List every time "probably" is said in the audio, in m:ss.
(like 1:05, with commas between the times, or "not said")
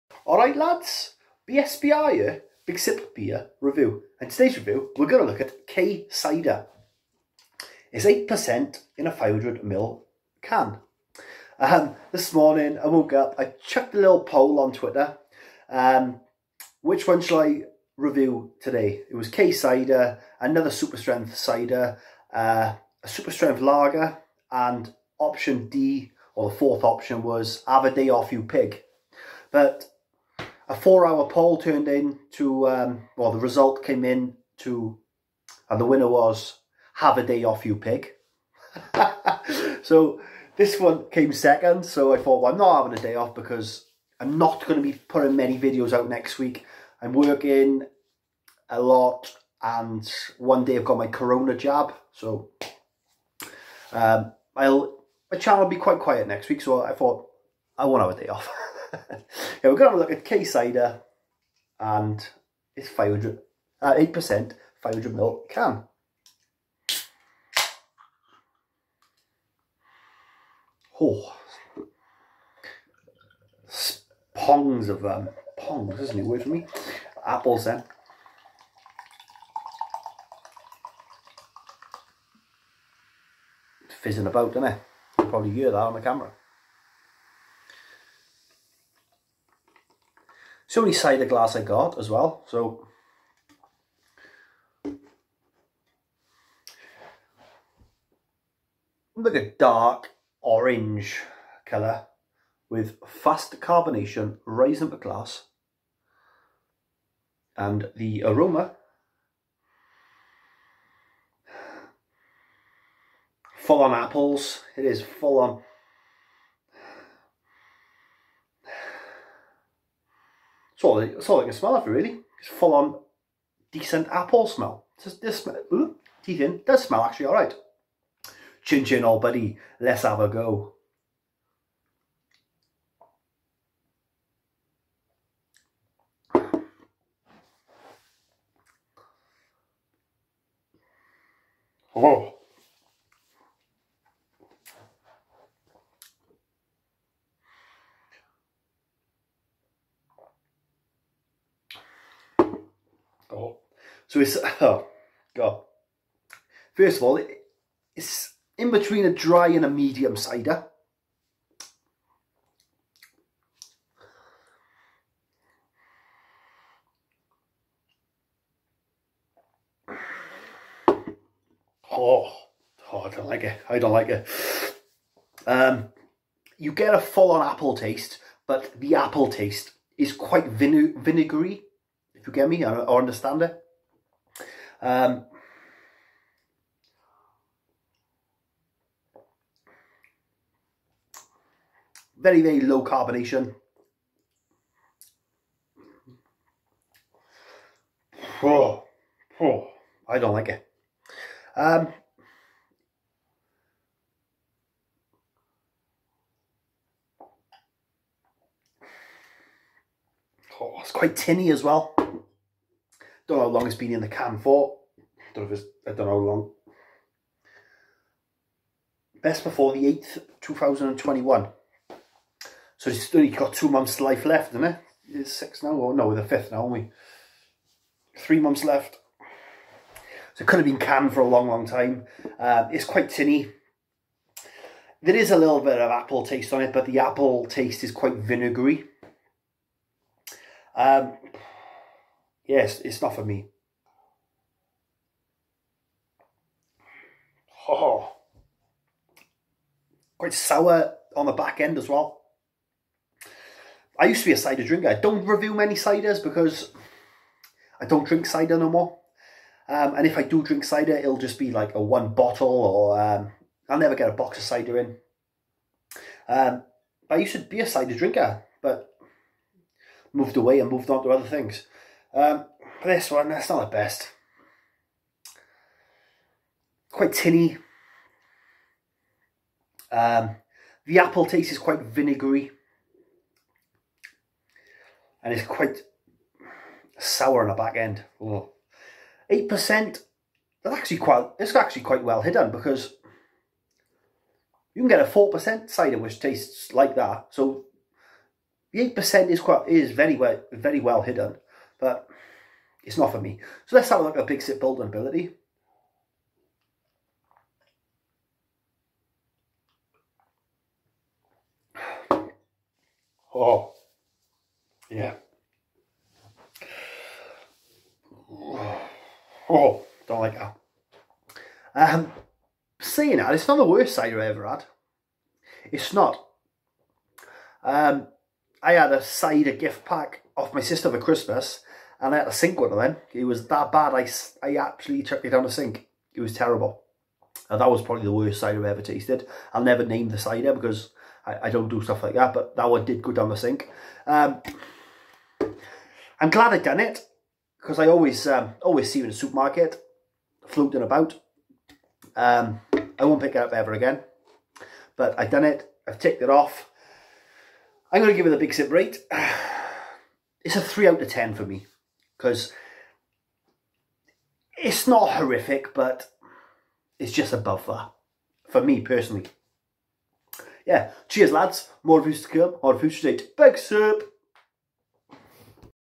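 1:25, 5:37.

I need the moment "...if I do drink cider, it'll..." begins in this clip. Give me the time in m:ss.
4:20.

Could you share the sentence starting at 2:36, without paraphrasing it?
First of all, it's in between a dry and a medium cider.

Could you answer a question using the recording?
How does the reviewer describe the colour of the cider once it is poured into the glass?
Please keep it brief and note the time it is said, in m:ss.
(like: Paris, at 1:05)
Dark orange, at 1:39.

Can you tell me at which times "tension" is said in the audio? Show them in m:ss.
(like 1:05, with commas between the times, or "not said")
not said.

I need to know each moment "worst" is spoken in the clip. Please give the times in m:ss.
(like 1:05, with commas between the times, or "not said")
5:23, 5:38.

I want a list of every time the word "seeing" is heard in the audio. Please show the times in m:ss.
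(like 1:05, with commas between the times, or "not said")
5:22.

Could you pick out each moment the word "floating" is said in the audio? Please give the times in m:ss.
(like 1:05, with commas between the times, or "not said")
5:50.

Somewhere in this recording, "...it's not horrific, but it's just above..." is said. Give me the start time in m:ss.
6:04.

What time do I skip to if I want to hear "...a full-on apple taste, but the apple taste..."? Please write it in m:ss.
2:56.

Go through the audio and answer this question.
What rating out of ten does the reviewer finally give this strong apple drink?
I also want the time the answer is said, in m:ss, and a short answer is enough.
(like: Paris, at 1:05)
3, at 6:00.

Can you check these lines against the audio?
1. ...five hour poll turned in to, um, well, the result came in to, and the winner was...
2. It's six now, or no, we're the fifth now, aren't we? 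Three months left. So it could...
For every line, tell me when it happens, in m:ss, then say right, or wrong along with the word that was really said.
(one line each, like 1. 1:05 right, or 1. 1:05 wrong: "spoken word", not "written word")
1. 0:30 wrong: "four", not "five"
2. 3:45 right.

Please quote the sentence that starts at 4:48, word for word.
8%, that's actually quite, it's actually quite well hidden because you can get a 4% cider which tastes like that.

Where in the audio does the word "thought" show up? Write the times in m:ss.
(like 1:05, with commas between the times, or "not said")
0:42, 0:56.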